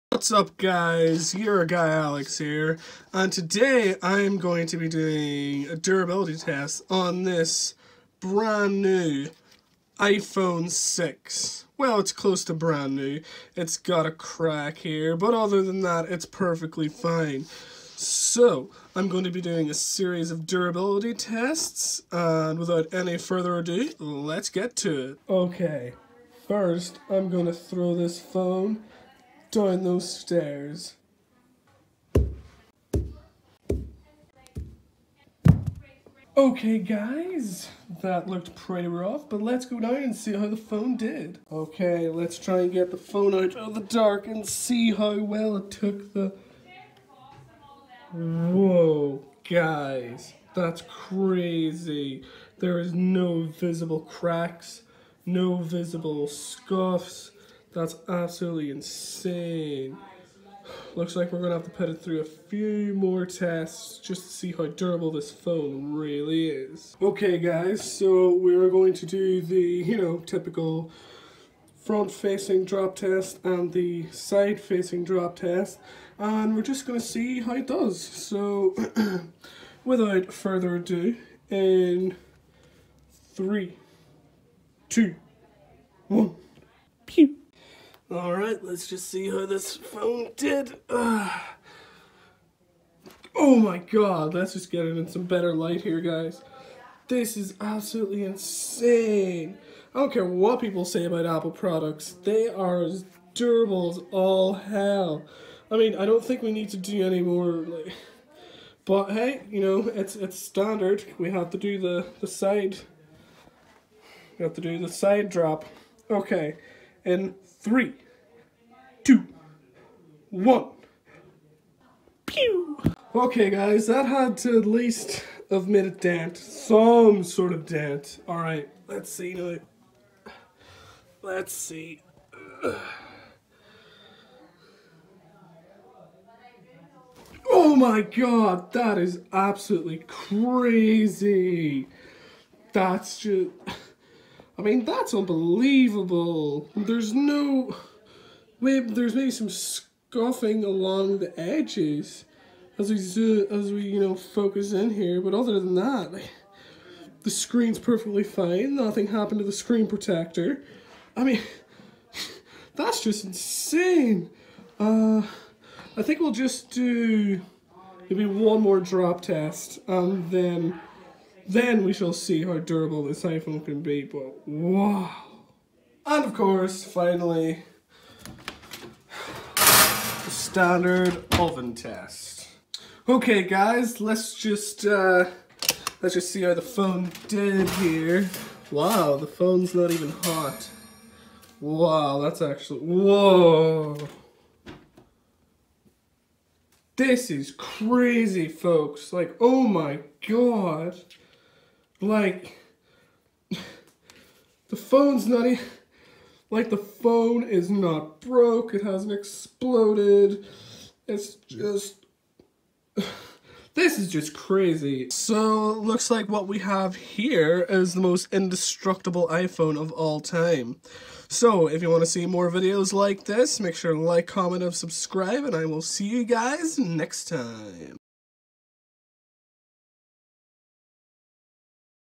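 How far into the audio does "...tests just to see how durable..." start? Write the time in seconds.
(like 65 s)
63 s.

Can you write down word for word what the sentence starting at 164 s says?
Uh, I think we'll just do maybe one more drop test and then...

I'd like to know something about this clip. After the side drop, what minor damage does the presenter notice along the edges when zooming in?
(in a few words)
scuffing.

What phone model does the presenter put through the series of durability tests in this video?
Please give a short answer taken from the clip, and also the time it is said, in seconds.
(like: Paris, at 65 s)
iPhone 6, at 9 s.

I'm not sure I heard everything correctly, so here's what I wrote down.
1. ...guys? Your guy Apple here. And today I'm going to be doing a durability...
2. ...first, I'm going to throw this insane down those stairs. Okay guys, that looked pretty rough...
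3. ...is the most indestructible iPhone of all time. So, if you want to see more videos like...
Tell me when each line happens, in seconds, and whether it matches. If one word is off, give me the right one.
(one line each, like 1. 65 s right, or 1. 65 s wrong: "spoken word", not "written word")
1. 0 s wrong: "Alex", not "Apple"
2. 26 s wrong: "phone", not "insane"
3. 217 s right.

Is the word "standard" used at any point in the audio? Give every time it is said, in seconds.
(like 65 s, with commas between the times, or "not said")
110 s, 180 s.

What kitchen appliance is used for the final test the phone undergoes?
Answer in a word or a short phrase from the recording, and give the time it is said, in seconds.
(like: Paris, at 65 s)
oven, at 181 s.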